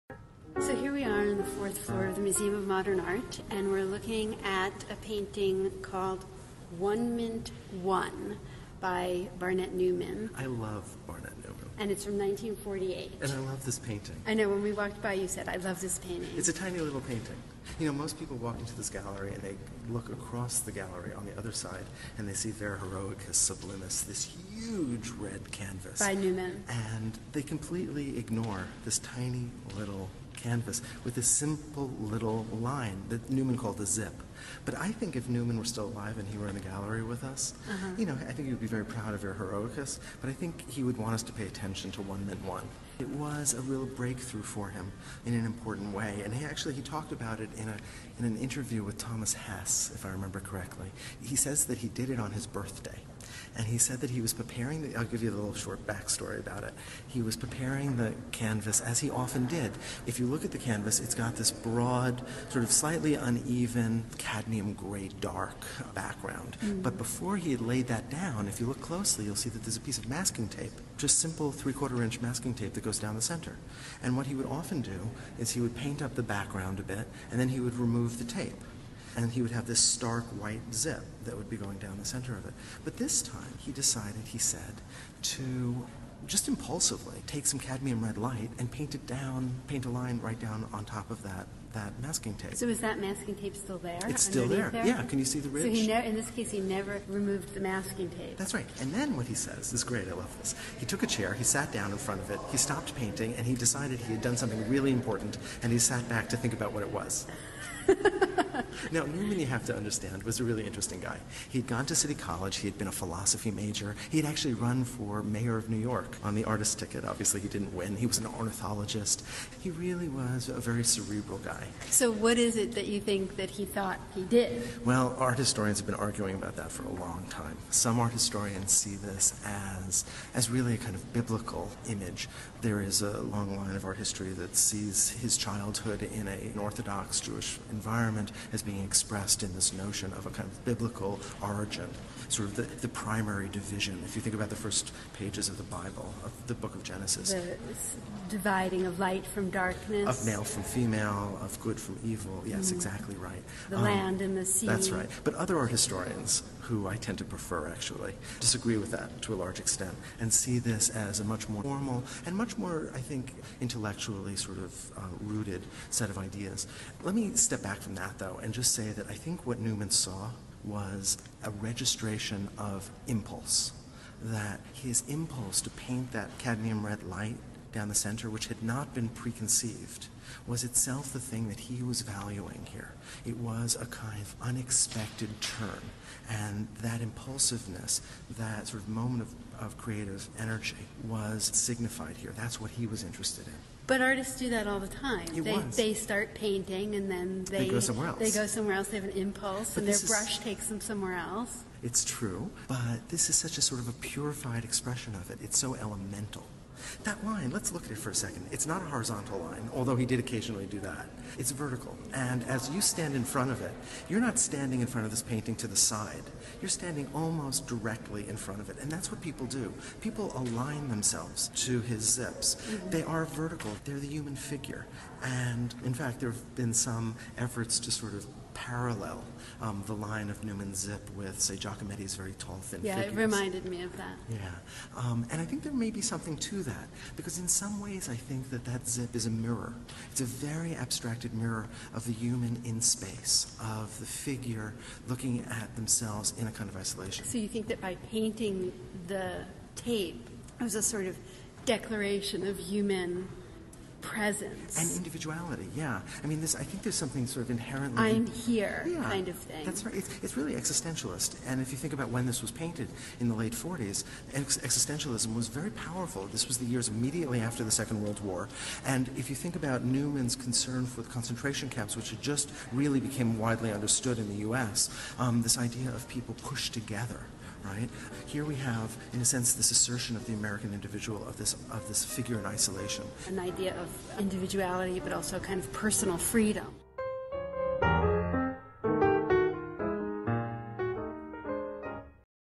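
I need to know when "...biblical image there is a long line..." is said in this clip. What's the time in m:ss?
2:11.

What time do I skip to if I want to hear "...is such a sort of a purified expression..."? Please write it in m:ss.
3:23.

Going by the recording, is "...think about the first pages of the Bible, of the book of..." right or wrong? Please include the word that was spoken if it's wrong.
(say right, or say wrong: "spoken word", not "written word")
right.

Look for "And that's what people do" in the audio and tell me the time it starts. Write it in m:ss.
3:38.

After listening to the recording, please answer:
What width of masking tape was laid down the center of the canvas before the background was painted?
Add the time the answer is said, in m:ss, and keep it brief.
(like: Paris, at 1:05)
3/4 inch, at 1:11.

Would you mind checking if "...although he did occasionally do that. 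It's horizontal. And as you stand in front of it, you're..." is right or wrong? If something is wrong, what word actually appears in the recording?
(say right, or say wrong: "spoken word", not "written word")
wrong: "vertical", not "horizontal".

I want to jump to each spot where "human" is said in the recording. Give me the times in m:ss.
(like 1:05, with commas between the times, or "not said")
3:44, 4:02, 4:12.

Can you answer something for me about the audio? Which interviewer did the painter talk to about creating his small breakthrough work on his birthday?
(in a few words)
Thomas Hess.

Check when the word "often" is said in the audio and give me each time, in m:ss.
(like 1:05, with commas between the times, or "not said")
0:59, 1:14.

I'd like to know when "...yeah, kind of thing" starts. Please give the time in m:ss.
4:18.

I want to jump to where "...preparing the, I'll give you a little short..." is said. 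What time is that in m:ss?
0:54.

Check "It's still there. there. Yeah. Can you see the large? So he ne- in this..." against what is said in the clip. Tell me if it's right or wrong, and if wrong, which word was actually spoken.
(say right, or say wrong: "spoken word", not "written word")
wrong: "ridge", not "large".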